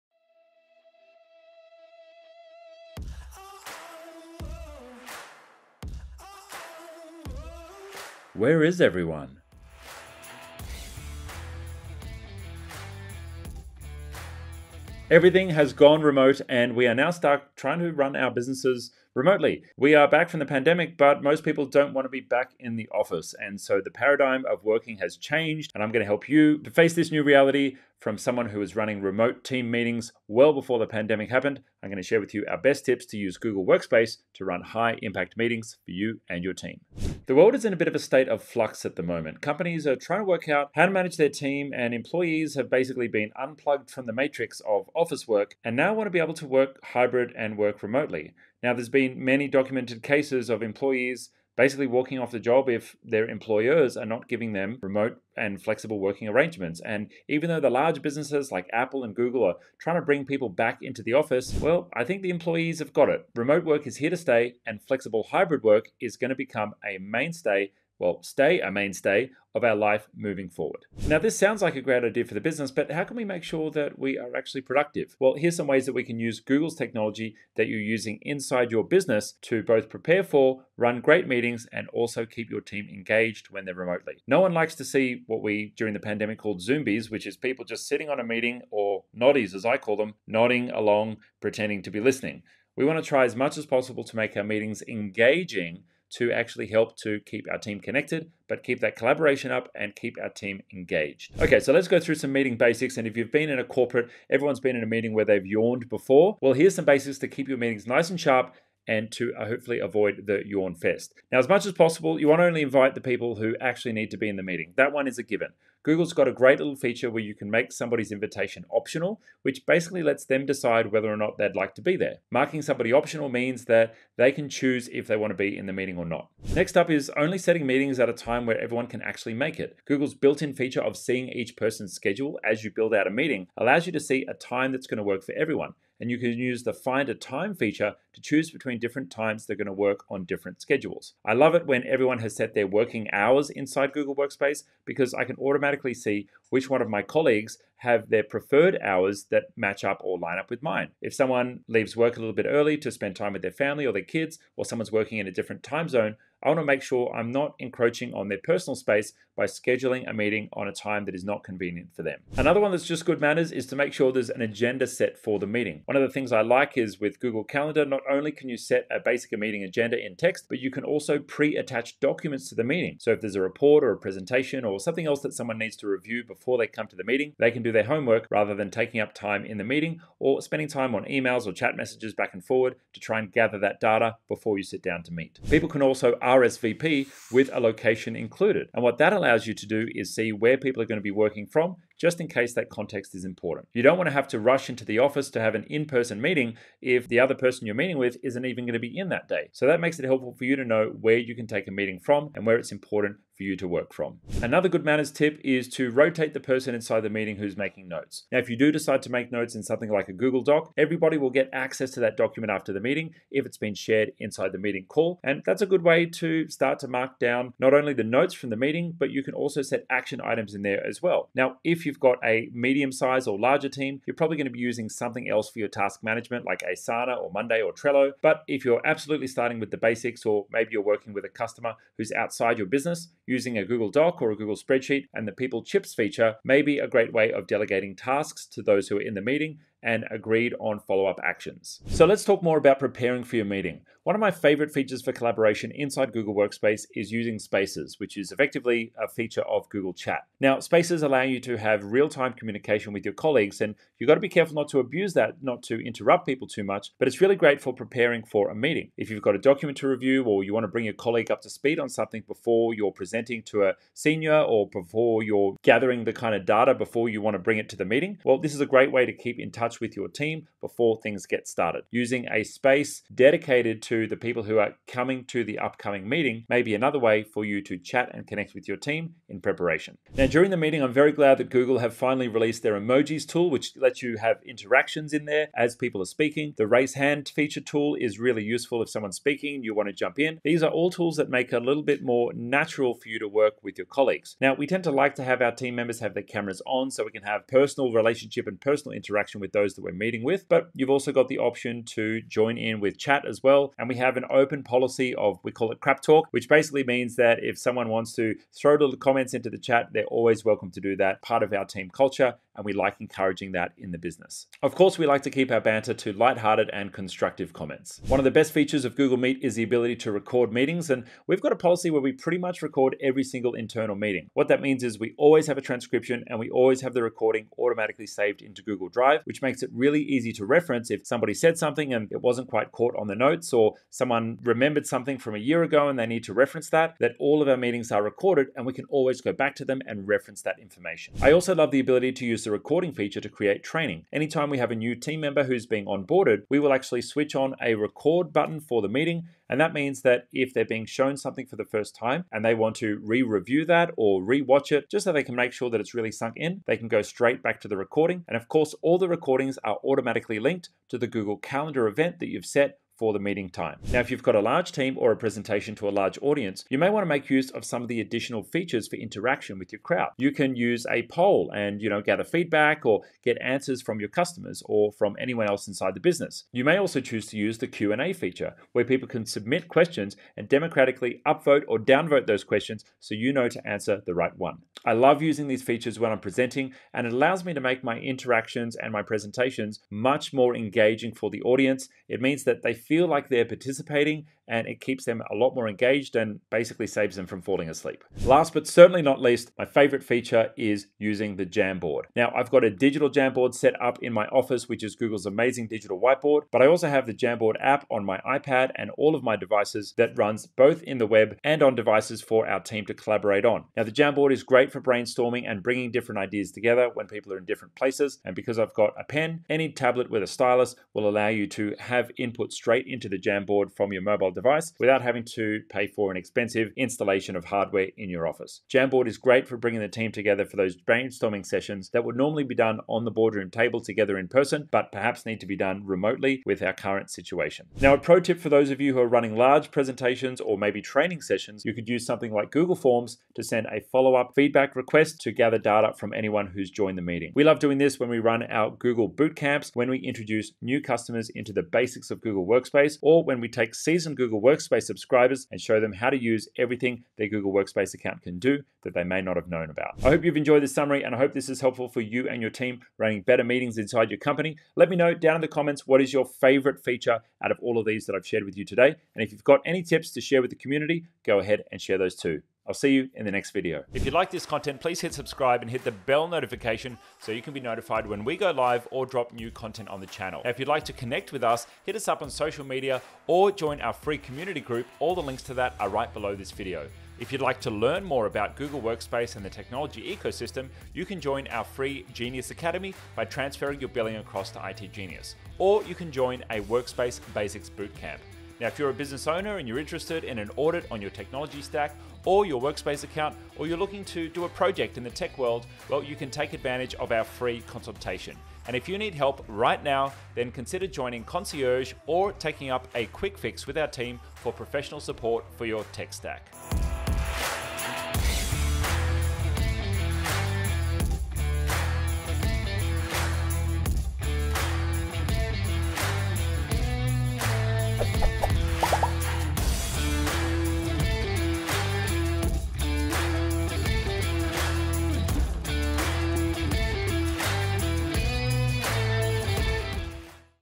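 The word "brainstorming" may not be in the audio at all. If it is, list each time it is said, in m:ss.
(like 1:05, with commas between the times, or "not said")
6:54, 7:10.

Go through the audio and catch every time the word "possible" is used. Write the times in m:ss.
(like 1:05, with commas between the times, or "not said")
1:33, 1:51.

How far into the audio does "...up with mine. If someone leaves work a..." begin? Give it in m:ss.
2:30.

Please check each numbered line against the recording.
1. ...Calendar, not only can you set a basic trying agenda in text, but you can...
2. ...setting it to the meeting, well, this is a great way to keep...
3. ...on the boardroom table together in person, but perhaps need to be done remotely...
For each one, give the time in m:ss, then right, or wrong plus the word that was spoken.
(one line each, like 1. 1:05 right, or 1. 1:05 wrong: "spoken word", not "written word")
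1. 2:47 wrong: "meeting", not "trying"
2. 4:27 wrong: "bring", not "setting"
3. 7:12 right.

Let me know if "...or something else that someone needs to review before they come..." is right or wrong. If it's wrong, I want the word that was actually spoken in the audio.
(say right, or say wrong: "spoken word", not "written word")
right.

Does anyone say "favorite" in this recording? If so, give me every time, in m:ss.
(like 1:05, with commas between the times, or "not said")
4:04, 6:39, 7:46.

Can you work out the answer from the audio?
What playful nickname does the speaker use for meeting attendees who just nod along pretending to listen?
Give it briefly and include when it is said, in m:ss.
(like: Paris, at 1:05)
noddies, at 1:29.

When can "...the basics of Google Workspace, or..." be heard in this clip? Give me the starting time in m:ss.
7:31.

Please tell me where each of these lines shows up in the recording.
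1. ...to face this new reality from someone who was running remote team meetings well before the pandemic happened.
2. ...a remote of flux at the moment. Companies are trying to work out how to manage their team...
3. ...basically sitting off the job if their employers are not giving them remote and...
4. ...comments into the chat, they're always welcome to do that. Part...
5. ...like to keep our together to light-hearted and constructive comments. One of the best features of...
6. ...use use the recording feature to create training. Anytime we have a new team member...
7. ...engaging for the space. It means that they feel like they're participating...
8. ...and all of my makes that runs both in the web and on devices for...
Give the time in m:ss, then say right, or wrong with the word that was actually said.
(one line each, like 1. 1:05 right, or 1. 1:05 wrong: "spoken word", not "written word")
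1. 0:26 right
2. 0:37 wrong: "state", not "remote"
3. 0:51 wrong: "walking", not "sitting"
4. 5:08 right
5. 5:15 wrong: "banter", not "together"
6. 5:42 right
7. 6:30 wrong: "audience", not "space"
8. 6:48 wrong: "devices", not "makes".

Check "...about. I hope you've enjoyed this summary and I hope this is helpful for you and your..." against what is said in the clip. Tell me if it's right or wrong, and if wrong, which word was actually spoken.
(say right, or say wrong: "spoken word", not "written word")
right.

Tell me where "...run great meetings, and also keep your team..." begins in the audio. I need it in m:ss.
1:20.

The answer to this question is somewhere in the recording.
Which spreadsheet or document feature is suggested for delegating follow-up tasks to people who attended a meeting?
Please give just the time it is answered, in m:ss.
3:55.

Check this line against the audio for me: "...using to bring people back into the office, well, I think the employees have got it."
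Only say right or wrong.
wrong.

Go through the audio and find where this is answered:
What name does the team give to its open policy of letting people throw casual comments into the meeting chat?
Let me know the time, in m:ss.
5:05.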